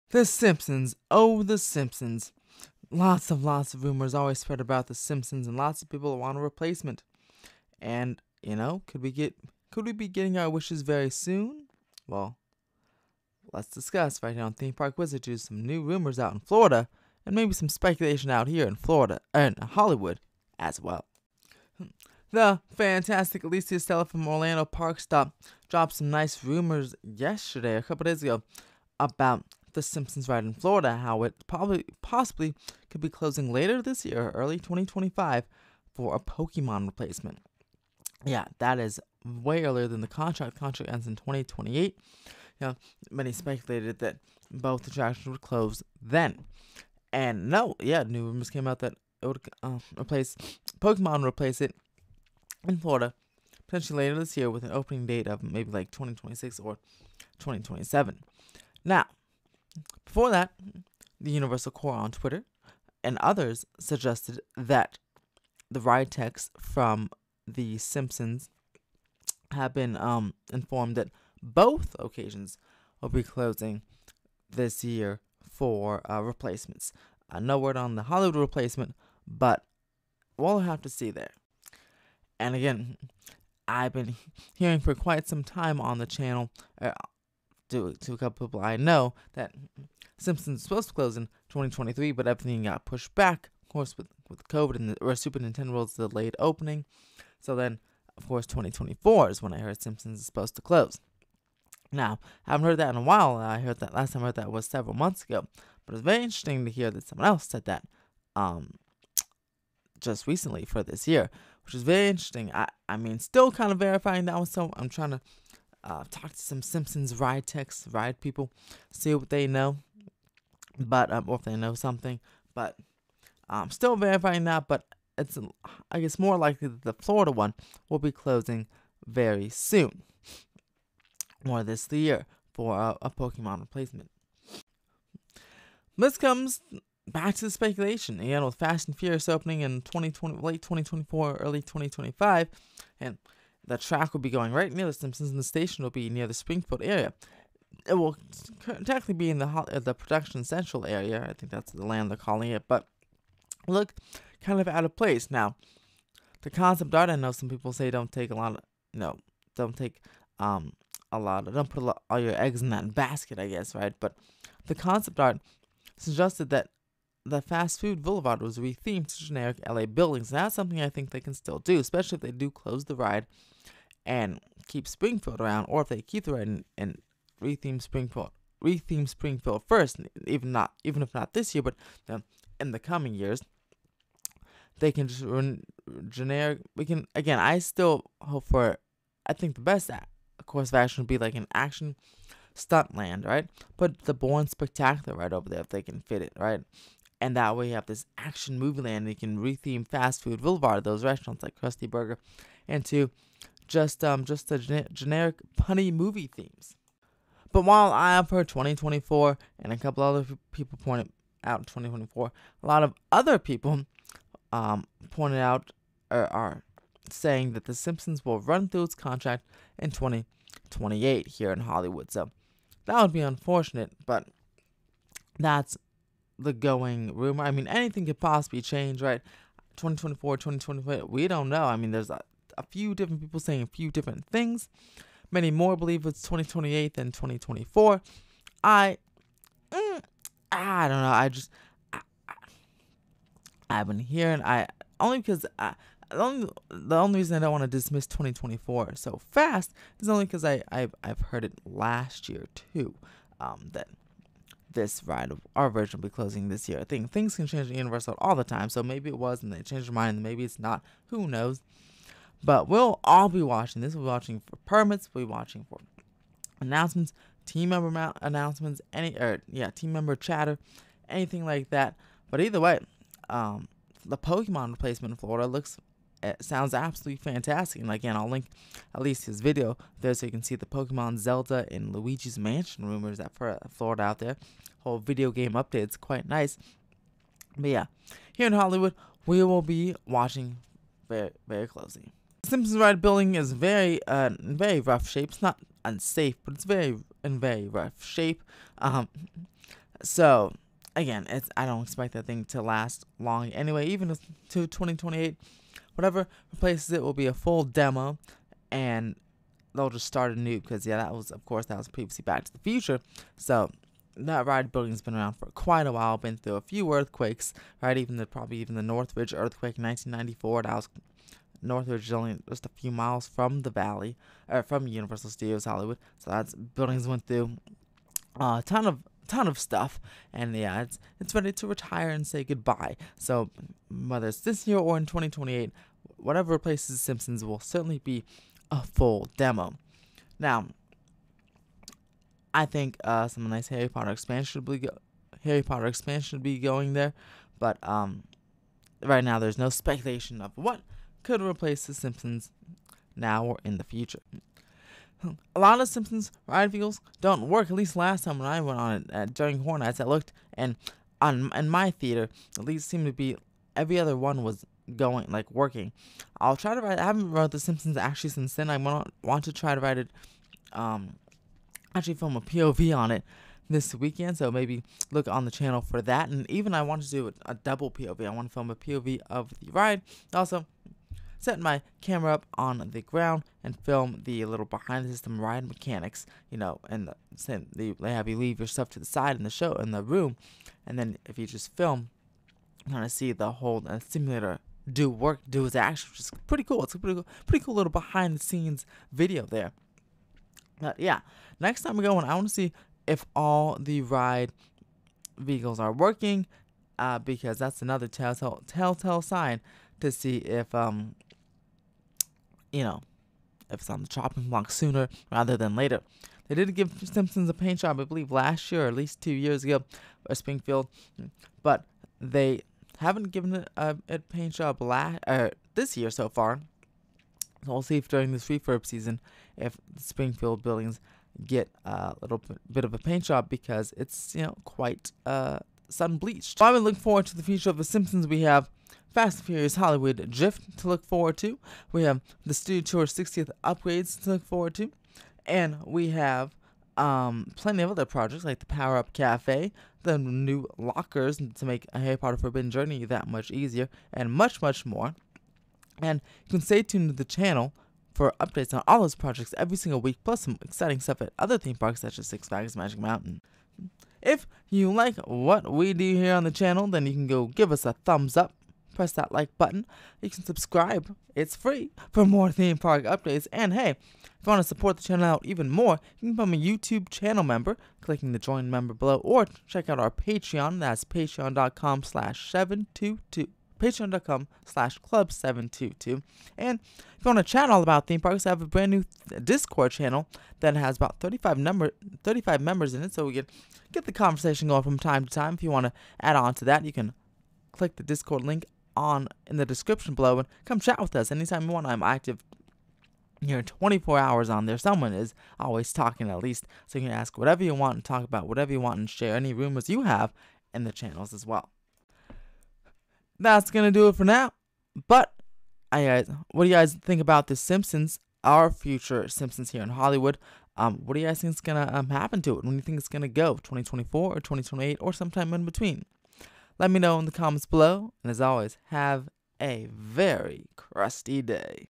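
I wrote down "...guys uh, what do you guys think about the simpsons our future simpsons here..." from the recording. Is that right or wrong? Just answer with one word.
right.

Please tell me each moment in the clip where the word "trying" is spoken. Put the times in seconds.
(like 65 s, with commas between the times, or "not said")
114 s.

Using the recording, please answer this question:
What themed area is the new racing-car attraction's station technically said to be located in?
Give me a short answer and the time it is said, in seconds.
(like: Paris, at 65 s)
Production Central, at 149 s.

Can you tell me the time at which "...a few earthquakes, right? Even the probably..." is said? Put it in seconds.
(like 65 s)
316 s.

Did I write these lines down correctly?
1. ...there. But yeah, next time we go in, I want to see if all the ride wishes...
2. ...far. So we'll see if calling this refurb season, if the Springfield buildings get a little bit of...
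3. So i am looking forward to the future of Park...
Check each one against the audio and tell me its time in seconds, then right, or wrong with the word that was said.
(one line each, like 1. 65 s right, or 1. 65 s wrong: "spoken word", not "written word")
1. 399 s wrong: "vehicles", not "wishes"
2. 426 s wrong: "during", not "calling"
3. 436 s wrong: "The", not "Park".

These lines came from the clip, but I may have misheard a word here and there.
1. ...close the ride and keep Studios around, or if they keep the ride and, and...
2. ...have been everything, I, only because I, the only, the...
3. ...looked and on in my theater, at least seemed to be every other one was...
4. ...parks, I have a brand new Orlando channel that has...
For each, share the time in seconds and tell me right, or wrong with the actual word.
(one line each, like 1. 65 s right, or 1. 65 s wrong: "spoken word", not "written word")
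1. 172 s wrong: "Springfield", not "Studios"
2. 243 s wrong: "hearing", not "everything"
3. 360 s right
4. 488 s wrong: "Discord", not "Orlando".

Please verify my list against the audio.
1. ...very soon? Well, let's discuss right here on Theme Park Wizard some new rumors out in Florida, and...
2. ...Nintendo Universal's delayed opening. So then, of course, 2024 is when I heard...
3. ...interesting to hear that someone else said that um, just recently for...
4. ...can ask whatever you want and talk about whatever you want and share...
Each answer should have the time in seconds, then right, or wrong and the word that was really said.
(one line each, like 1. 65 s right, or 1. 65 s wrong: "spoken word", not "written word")
1. 10 s right
2. 95 s wrong: "World", not "Universal"
3. 106 s right
4. 507 s right.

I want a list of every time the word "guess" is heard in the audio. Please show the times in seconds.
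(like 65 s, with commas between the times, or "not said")
125 s, 163 s.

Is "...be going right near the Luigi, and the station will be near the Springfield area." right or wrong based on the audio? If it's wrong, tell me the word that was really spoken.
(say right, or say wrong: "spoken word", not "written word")
wrong: "Simpsons", not "Luigi".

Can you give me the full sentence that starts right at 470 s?
You can subscribe, it's free, for more theme park updates.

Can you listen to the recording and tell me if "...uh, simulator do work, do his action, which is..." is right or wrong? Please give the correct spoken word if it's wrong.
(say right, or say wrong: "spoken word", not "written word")
right.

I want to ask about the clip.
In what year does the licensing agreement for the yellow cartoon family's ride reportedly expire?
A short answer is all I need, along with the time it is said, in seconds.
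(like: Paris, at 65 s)
2028, at 40 s.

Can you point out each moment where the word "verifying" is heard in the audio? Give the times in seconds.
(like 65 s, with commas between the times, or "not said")
113 s, 123 s.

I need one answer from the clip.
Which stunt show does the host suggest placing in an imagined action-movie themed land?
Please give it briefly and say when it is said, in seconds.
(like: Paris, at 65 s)
Bourne Stuntacular, at 194 s.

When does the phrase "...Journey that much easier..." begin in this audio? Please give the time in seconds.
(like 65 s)
452 s.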